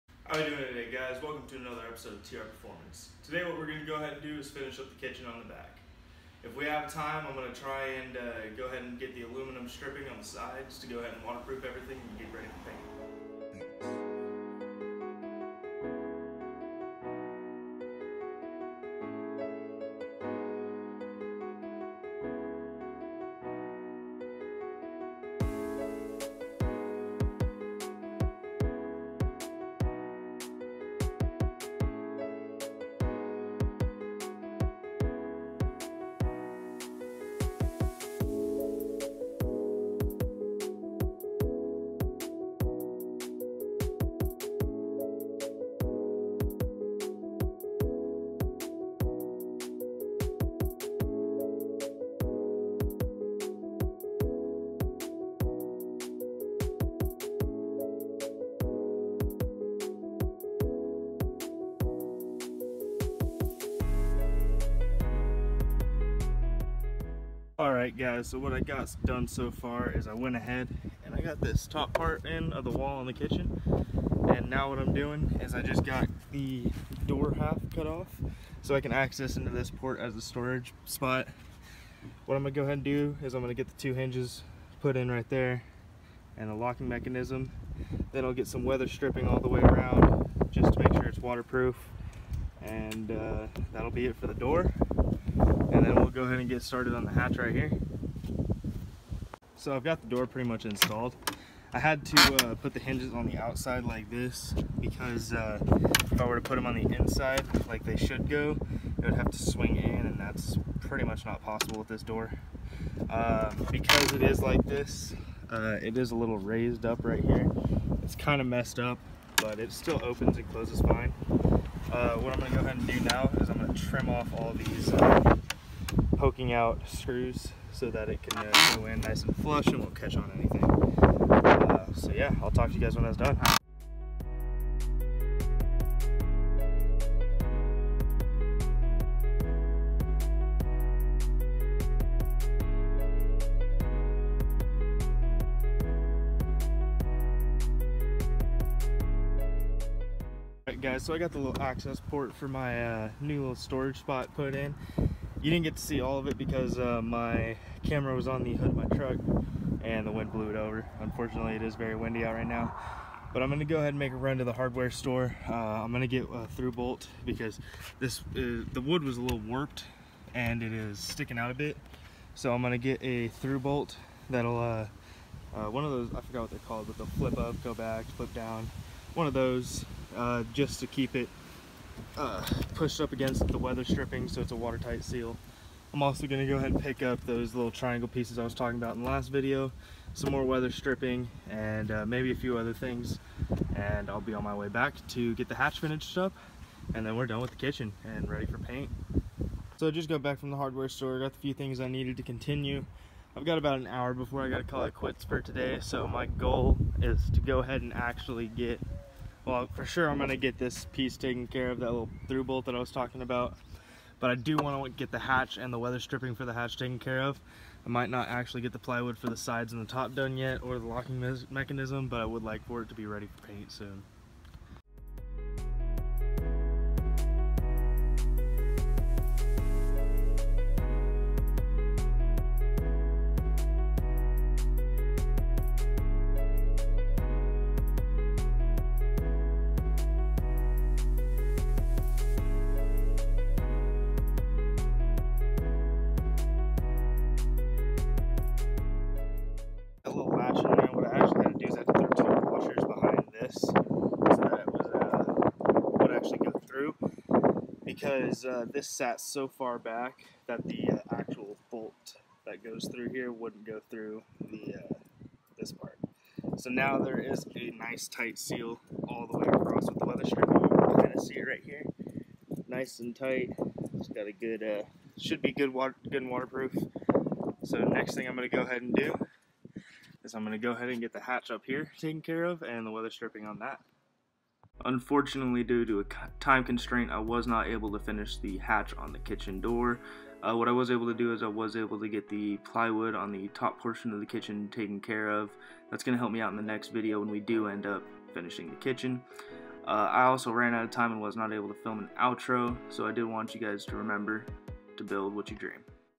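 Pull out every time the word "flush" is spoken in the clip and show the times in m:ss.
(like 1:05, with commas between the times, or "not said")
2:09.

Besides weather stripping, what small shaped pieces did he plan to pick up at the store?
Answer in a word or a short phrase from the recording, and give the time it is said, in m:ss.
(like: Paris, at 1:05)
Triangle pieces, at 3:07.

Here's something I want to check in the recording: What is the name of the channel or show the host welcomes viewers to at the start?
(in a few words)
TR Performance.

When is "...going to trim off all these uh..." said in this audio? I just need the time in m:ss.
2:03.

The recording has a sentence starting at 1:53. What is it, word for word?
Uh, because it is like this, uh, it is a little raised up right here.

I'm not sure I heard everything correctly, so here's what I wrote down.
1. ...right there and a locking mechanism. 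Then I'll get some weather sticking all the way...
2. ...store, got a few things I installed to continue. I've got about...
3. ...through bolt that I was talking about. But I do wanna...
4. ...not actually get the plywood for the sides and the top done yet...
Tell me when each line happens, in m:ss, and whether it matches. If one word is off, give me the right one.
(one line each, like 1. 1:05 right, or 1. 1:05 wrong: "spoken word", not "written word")
1. 1:25 wrong: "stripping", not "sticking"
2. 3:20 wrong: "needed", not "installed"
3. 3:32 right
4. 3:38 right.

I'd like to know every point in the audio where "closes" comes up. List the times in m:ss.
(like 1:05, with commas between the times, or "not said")
2:00.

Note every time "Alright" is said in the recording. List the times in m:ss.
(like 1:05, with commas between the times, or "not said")
1:07, 2:30.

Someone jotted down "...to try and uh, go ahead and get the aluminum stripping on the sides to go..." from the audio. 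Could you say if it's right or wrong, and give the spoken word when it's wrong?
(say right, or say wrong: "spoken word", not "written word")
right.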